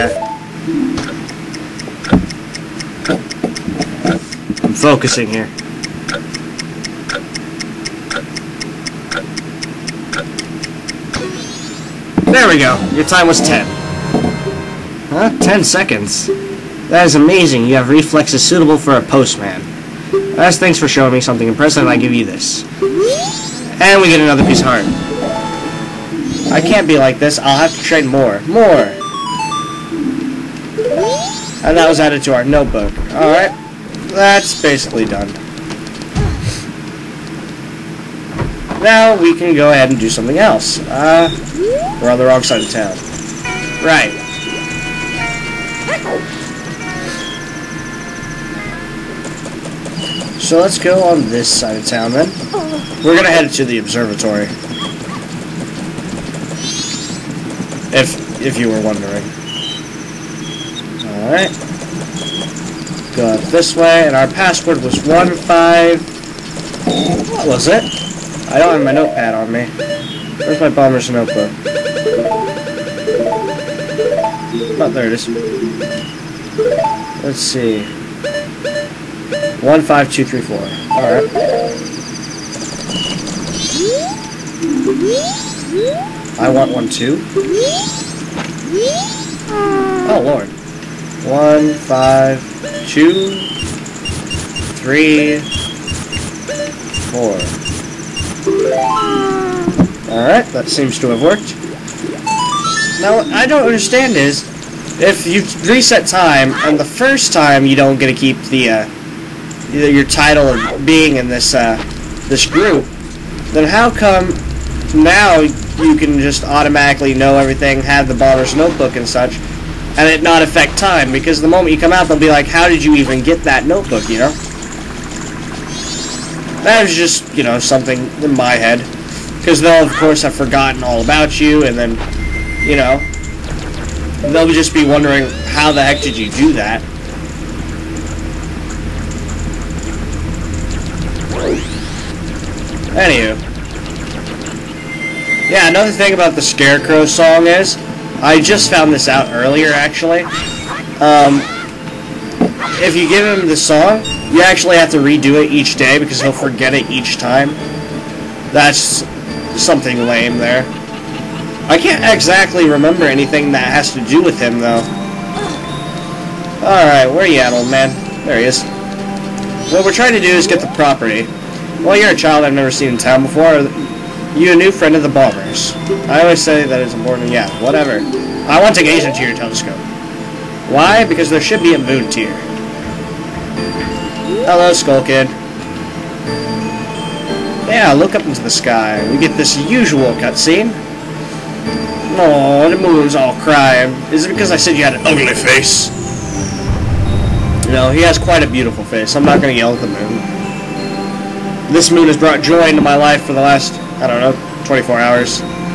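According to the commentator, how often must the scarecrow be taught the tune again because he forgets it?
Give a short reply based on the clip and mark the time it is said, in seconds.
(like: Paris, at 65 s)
each day, at 155 s.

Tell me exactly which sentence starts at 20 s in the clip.
As thanks for showing me something impressive, I give you this.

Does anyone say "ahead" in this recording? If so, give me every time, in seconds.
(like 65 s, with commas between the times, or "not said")
39 s.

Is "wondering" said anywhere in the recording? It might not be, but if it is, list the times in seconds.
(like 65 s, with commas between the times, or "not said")
58 s, 134 s.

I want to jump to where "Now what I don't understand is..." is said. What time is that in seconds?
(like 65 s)
103 s.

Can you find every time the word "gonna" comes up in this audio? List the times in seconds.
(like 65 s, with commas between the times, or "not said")
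53 s, 199 s.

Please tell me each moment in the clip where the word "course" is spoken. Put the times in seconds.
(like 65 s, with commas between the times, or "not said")
129 s.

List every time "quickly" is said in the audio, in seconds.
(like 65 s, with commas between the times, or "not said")
not said.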